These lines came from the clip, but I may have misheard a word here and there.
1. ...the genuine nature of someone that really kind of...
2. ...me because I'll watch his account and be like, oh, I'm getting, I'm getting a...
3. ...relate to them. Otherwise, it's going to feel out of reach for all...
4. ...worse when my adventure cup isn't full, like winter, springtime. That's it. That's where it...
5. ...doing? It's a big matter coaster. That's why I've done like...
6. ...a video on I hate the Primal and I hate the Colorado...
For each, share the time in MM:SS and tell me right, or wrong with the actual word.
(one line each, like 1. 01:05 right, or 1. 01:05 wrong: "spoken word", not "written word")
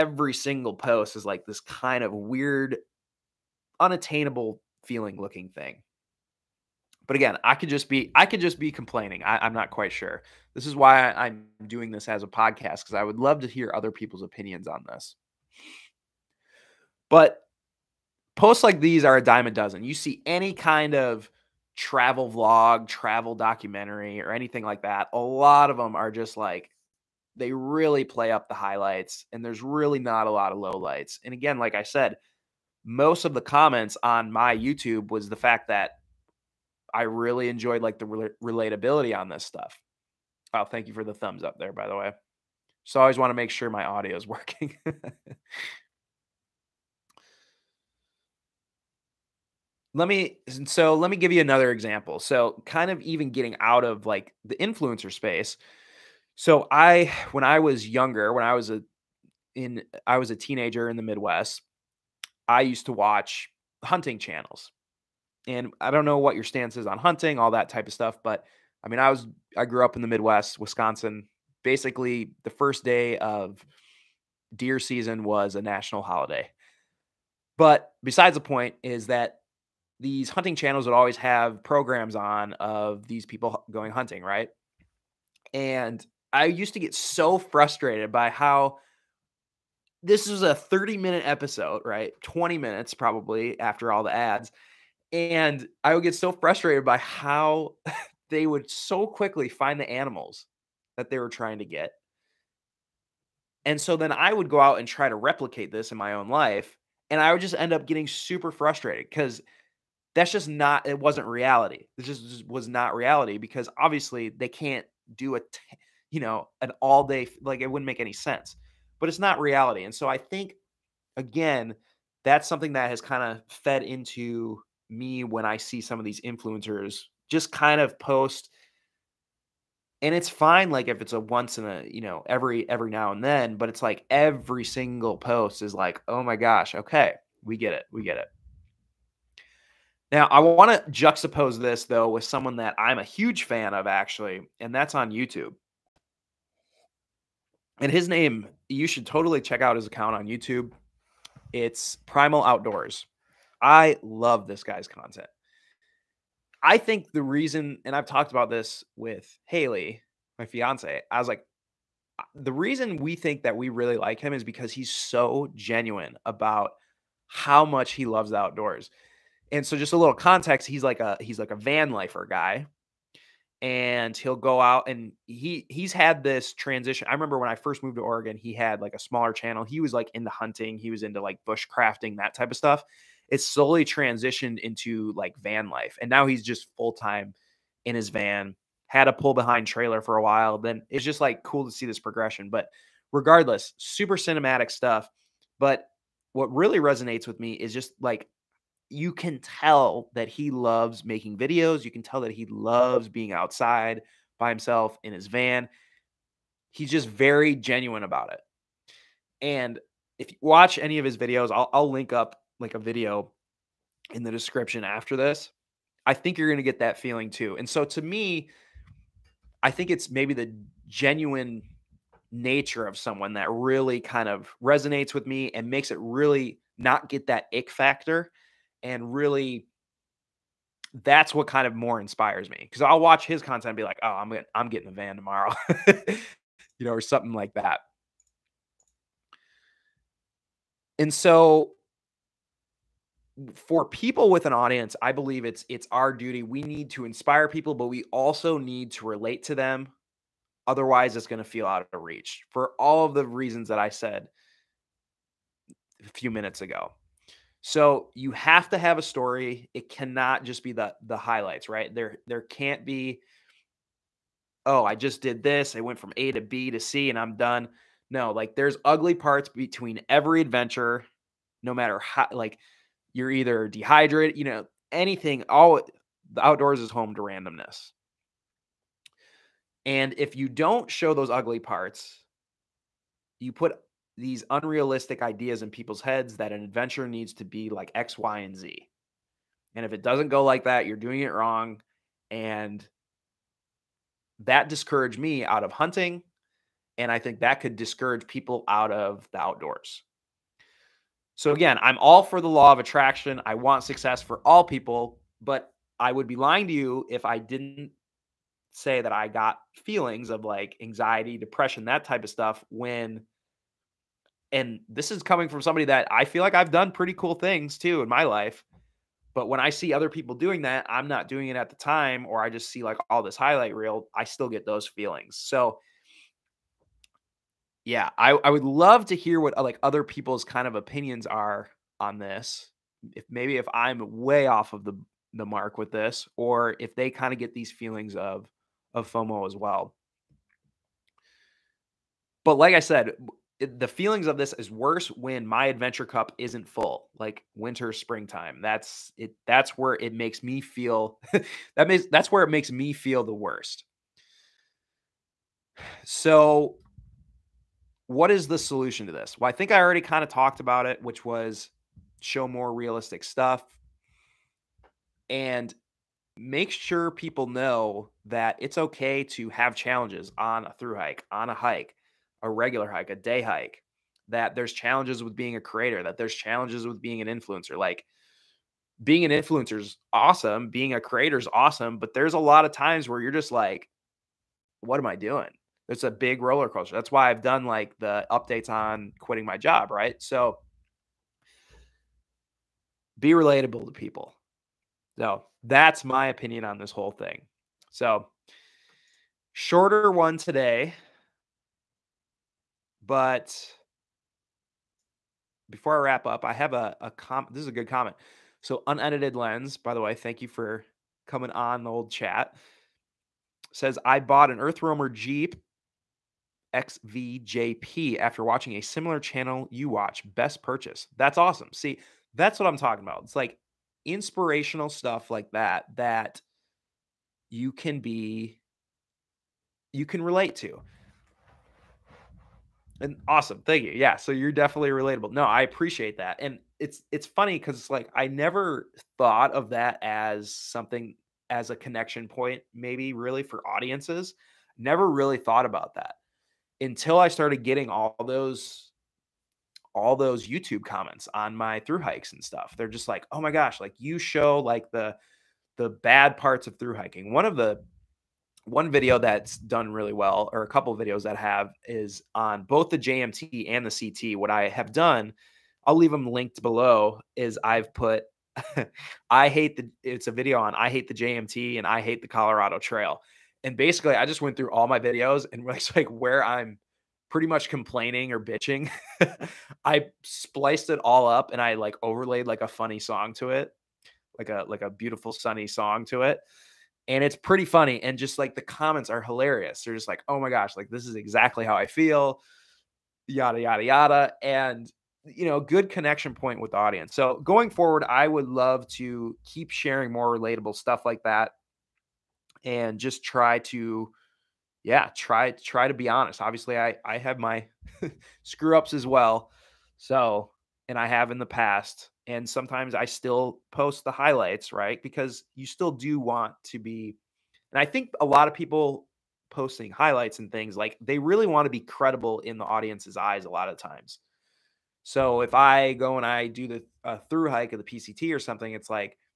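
1. 03:40 right
2. 03:52 wrong: "content", not "account"
3. 04:09 right
4. 05:44 right
5. 06:25 wrong: "roller", not "matter"
6. 07:50 wrong: "JMT", not "Primal".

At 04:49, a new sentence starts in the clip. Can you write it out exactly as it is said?
And if it doesn't go like that, you're doing it wrong.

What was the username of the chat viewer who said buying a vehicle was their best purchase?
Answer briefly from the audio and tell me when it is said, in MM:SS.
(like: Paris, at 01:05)
unedited lens, at 06:48.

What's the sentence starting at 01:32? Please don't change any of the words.
20 minutes probably after all the ads.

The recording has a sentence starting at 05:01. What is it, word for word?
So, again, I'm all for the law of attraction.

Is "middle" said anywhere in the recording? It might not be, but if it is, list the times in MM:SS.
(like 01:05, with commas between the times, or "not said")
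not said.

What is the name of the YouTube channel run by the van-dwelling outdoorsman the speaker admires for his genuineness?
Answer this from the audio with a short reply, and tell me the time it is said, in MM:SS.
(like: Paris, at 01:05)
Primal Outdoors, at 02:32.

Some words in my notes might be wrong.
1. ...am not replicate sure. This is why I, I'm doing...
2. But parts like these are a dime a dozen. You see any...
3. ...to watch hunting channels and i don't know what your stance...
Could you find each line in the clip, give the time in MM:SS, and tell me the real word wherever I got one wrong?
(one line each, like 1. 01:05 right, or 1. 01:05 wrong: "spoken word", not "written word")
1. 00:09 wrong: "quite", not "replicate"
2. 00:17 wrong: "posts", not "parts"
3. 01:02 right.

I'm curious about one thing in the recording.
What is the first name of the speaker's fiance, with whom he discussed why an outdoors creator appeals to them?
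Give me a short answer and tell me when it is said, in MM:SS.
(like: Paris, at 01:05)
Haley, at 02:39.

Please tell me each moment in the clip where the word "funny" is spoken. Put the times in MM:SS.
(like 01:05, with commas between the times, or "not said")
07:17, 08:02, 08:07.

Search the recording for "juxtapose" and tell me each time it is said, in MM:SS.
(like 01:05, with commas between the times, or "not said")
02:20.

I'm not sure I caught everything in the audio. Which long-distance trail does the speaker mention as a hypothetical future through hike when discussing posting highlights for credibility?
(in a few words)
PCT.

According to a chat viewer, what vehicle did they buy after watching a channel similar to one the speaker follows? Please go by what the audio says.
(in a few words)
Earth Roamer Jeep XVJP.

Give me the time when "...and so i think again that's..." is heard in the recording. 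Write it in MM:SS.
01:59.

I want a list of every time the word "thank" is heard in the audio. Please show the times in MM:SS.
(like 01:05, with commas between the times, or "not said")
00:40, 06:50, 07:13.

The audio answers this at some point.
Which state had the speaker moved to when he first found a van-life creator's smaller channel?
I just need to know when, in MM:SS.
02:58.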